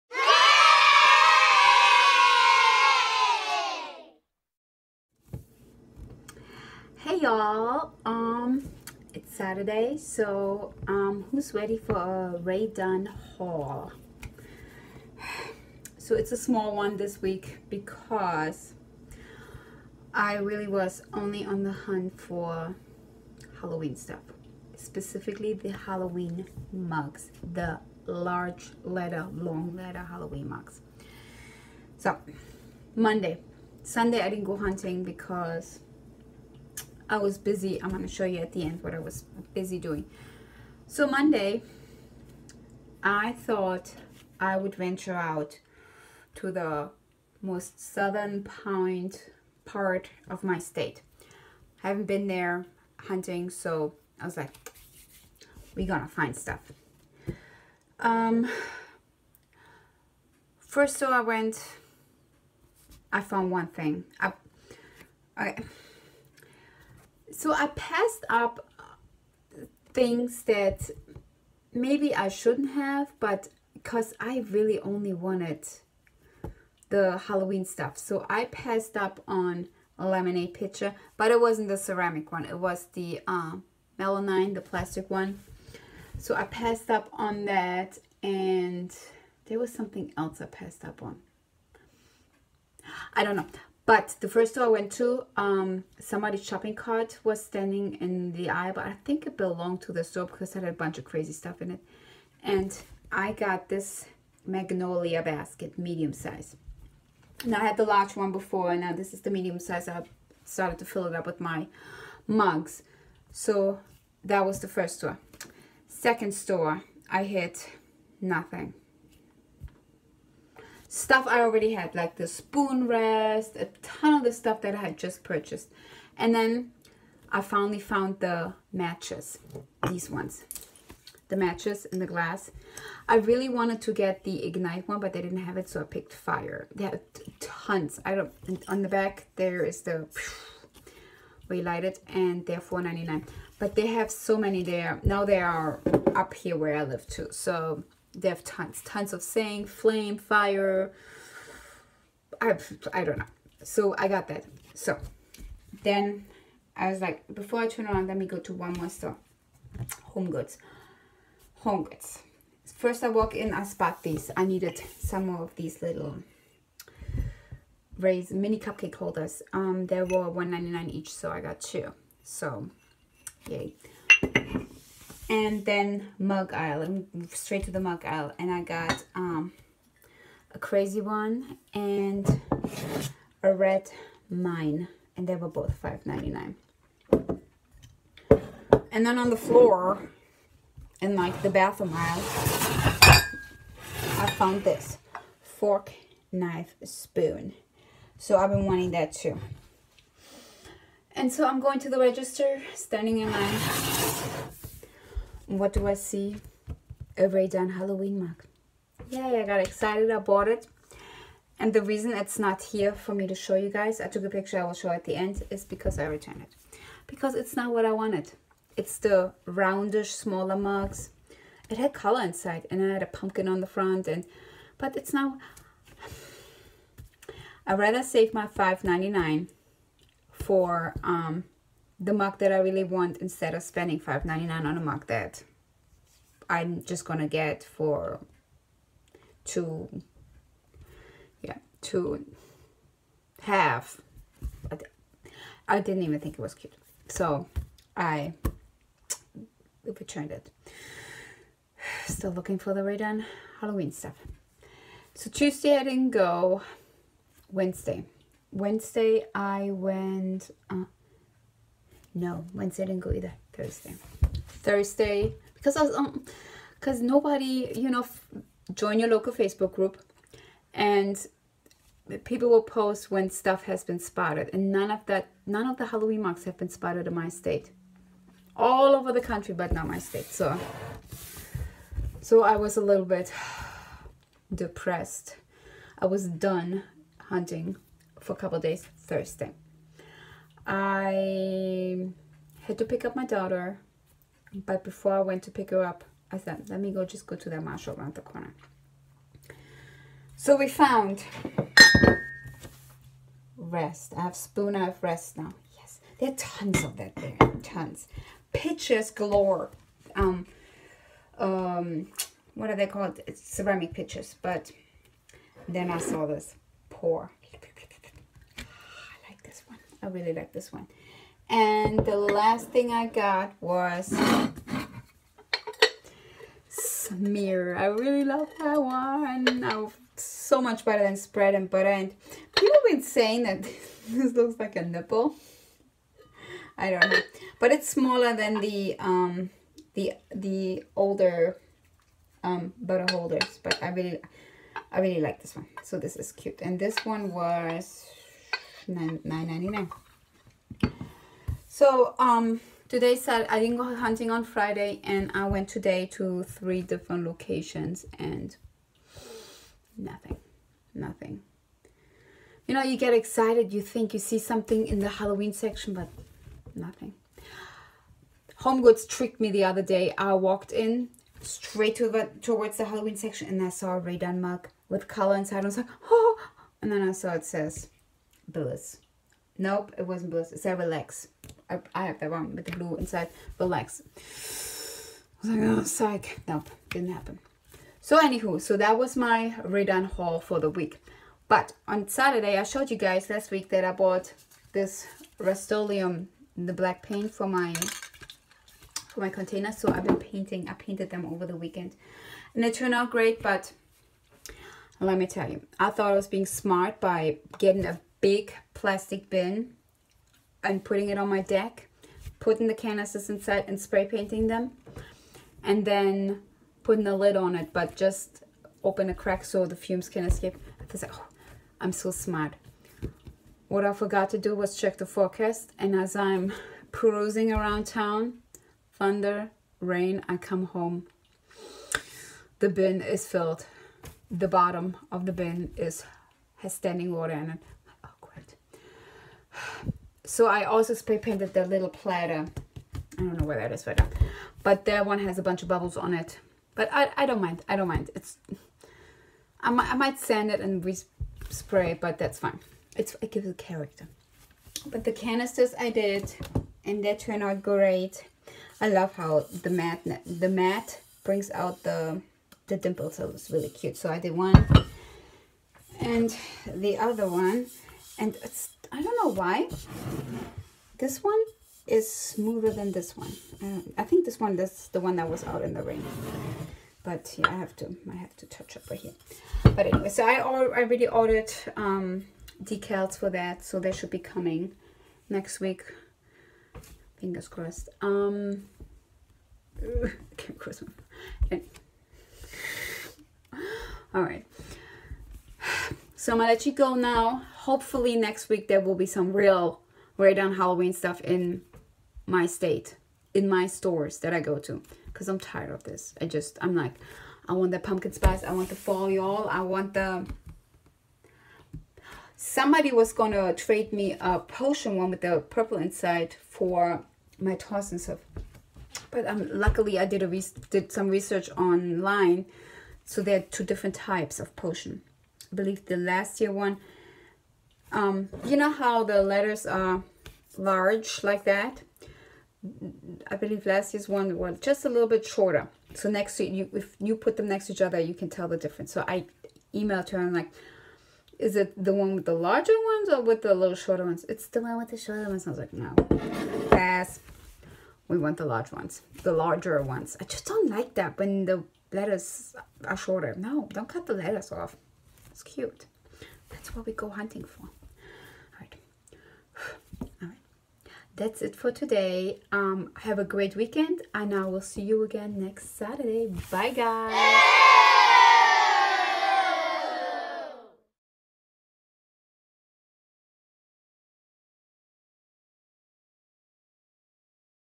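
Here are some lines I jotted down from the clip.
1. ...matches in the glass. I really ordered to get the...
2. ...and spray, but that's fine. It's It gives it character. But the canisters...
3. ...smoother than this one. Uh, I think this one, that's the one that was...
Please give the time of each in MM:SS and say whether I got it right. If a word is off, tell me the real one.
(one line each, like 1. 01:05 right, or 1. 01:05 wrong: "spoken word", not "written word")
1. 02:11 wrong: "wanted", not "ordered"
2. 07:30 right
3. 07:52 right.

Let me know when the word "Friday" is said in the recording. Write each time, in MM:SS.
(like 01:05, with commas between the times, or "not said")
05:54.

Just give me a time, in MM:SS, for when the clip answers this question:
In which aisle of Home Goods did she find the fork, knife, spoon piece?
03:11.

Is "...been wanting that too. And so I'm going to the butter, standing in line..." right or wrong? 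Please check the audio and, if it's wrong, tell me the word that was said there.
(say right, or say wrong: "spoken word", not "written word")
wrong: "register", not "butter".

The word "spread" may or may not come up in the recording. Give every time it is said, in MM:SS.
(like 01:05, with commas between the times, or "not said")
05:31.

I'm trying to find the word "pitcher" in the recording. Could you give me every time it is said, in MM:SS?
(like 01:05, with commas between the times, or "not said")
01:20, 05:08, 05:13.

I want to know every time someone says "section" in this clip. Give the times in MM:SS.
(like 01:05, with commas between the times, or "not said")
06:05, 06:13.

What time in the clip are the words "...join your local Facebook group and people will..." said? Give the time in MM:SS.
04:28.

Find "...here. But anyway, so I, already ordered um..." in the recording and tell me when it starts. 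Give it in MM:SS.
07:58.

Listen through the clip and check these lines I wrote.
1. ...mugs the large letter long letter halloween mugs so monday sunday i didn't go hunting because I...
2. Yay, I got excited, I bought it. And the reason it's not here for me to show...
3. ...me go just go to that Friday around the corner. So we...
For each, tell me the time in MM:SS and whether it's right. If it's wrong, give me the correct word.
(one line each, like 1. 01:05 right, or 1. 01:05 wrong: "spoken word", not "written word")
1. 00:26 right
2. 03:29 right
3. 04:56 wrong: "Marshall", not "Friday".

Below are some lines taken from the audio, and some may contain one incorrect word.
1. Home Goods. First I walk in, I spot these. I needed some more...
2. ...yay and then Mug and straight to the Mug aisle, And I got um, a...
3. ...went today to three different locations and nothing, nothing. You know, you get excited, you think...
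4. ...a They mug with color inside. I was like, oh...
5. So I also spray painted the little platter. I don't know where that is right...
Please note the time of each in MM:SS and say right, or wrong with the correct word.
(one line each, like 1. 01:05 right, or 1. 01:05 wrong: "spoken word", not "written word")
1. 02:41 right
2. 02:53 right
3. 05:55 right
4. 06:13 wrong: "Ray", not "They"
5. 07:20 right.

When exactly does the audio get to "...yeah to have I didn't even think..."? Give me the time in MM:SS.
04:01.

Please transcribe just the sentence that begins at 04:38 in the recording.
All over the country but not my state.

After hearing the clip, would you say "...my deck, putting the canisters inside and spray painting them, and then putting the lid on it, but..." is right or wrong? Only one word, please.
right.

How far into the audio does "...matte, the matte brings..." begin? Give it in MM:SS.
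07:39.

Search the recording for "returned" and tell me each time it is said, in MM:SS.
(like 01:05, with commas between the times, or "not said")
03:36, 04:09.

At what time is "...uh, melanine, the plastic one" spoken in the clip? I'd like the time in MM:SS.
01:23.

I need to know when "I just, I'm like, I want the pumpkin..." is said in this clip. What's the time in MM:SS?
08:26.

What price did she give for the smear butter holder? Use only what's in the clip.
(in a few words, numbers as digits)
$9.99.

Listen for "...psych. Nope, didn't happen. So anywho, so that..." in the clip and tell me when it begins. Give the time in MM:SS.
06:25.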